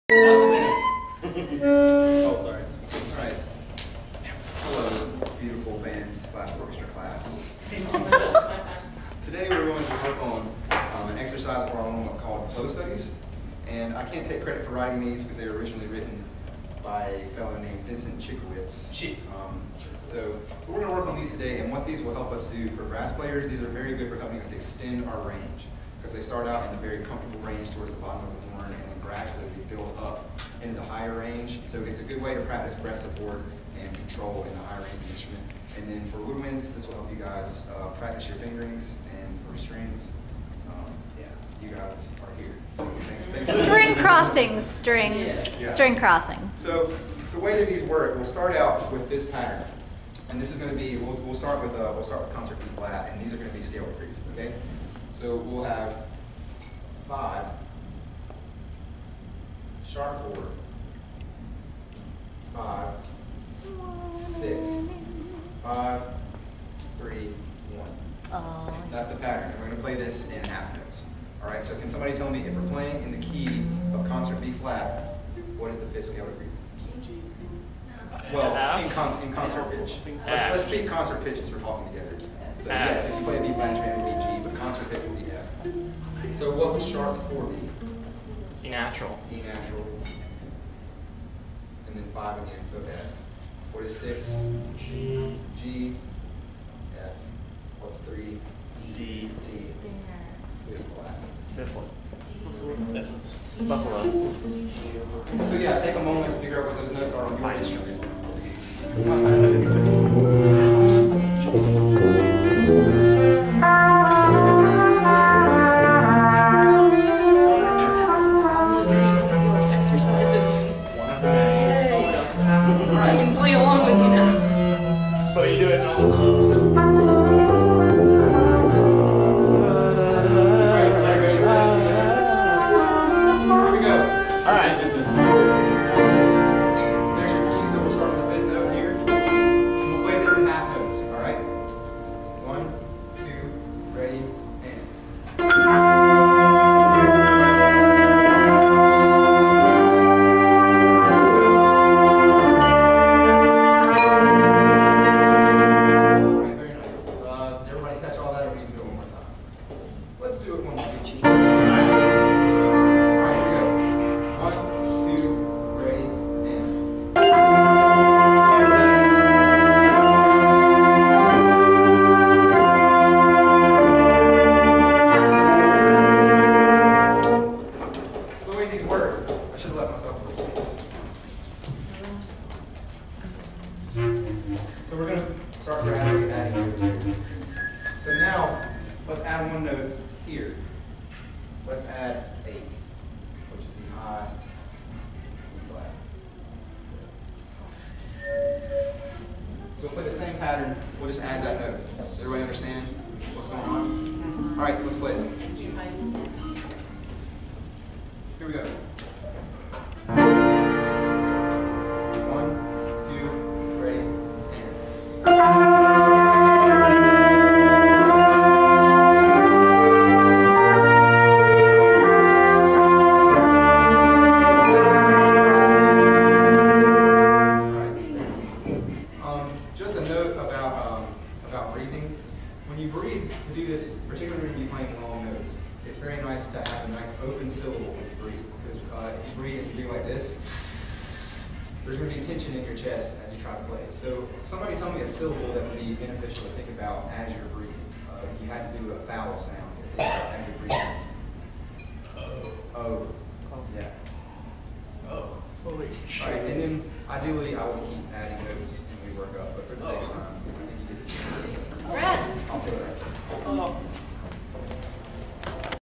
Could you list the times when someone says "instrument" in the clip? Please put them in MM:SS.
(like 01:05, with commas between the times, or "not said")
00:35, 01:47.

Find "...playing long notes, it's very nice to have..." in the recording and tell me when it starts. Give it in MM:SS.
03:54.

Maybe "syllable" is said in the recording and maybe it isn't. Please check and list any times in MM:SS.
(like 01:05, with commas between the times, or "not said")
03:57, 04:05.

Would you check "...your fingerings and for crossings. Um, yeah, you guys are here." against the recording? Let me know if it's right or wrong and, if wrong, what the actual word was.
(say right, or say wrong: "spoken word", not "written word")
wrong: "strings", not "crossings".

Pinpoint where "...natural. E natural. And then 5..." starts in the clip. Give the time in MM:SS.
01:28.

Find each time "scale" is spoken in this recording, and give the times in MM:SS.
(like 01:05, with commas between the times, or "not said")
00:53, 01:16.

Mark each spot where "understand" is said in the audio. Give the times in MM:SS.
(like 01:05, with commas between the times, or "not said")
03:22.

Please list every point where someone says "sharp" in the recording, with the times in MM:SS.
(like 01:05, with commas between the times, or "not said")
00:59, 01:26.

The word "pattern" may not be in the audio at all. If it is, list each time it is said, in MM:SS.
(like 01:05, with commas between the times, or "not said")
00:49, 01:09, 03:20.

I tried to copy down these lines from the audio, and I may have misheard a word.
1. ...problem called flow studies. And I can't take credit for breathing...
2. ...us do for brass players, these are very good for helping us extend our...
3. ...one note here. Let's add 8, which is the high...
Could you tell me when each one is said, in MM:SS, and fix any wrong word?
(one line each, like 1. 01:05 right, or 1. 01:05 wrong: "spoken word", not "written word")
1. 00:11 wrong: "writing", not "breathing"
2. 00:22 right
3. 03:09 right.